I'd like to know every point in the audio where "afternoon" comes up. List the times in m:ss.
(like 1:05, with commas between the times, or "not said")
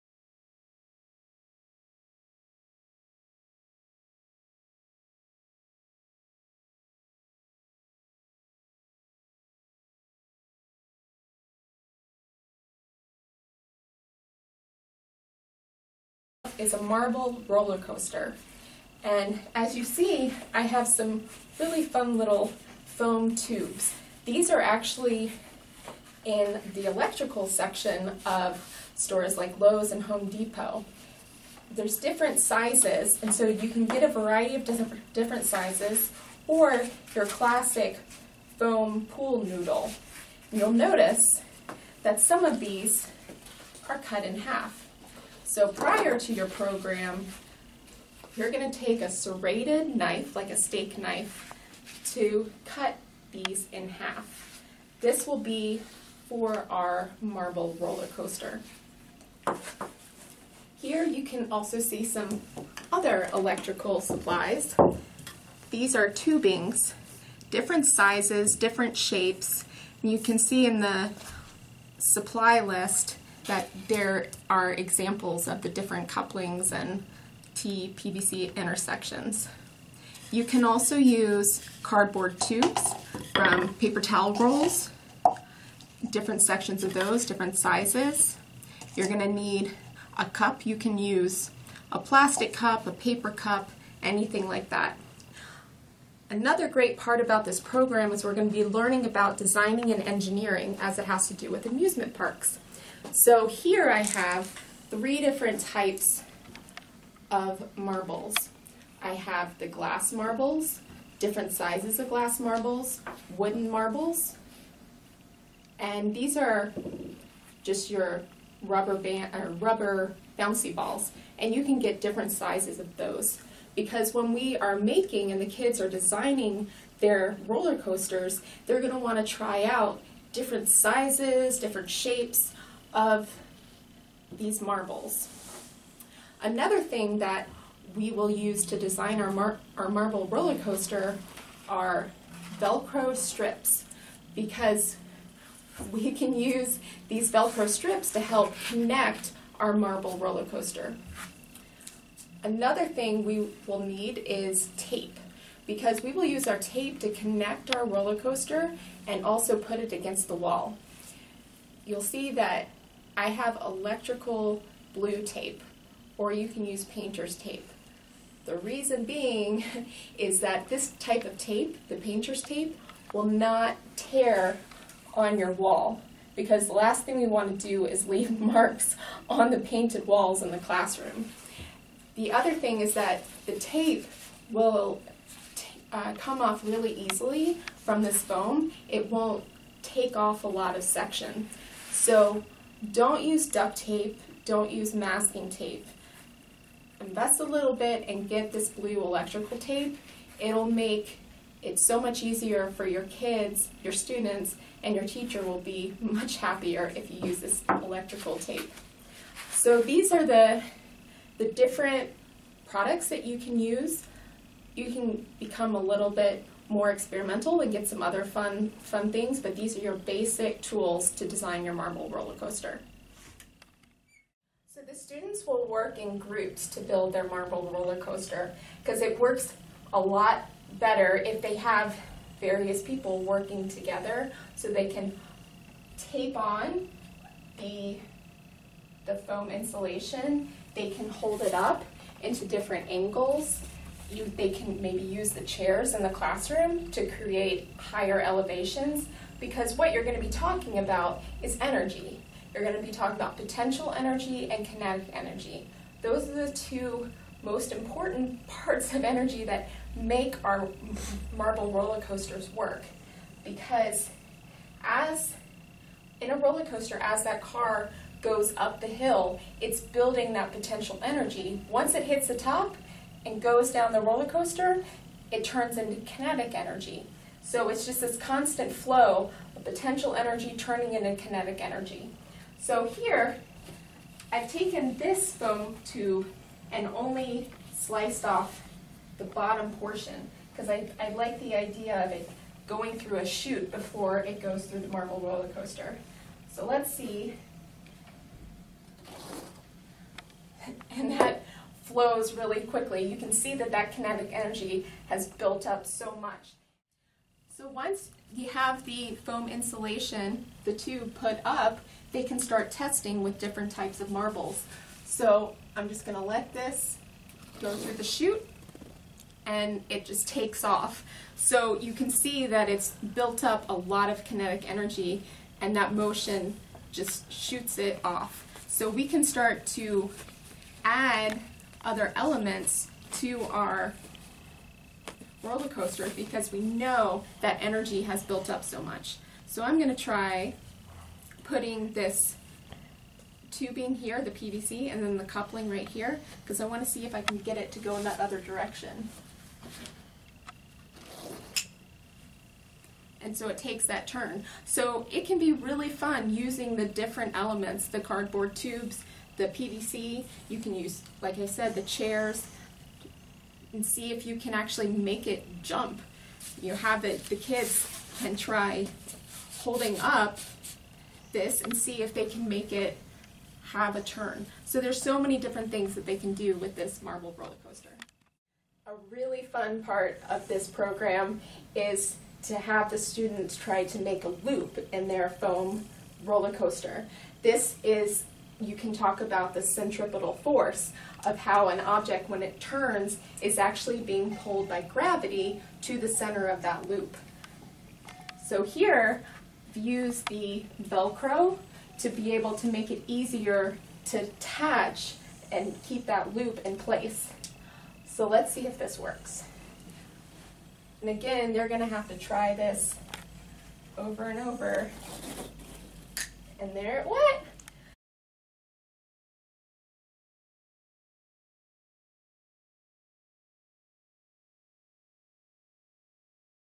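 not said.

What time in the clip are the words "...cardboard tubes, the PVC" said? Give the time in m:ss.
5:57.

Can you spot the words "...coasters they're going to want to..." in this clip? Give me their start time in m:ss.
2:07.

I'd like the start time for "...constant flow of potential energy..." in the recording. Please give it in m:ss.
4:38.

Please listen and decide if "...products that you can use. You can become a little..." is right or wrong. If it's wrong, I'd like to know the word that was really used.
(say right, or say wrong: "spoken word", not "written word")
right.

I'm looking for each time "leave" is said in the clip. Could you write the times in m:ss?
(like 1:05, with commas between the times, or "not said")
2:58.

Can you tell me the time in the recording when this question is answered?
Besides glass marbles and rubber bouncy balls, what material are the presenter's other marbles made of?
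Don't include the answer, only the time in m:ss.
1:53.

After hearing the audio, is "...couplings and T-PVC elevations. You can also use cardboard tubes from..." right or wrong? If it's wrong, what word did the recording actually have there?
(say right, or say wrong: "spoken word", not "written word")
wrong: "intersections", not "elevations".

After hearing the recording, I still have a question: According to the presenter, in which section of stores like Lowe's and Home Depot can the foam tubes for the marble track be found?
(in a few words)
electrical section.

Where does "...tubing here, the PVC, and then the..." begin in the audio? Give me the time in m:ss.
5:43.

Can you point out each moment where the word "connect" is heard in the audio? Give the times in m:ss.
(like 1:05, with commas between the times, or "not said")
2:28, 2:37.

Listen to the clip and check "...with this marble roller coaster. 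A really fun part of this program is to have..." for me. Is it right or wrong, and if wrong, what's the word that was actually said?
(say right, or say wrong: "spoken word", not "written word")
right.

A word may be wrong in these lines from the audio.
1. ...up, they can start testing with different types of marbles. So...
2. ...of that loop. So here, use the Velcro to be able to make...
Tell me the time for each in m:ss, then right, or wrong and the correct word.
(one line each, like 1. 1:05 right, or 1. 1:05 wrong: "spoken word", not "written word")
1. 5:11 right
2. 6:36 right.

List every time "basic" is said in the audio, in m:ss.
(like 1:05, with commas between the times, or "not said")
3:39.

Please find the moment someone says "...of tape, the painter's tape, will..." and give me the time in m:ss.
2:51.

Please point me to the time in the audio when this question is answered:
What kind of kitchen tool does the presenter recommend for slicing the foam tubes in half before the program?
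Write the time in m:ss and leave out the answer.
0:49.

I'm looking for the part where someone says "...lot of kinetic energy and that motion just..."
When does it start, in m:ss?
5:23.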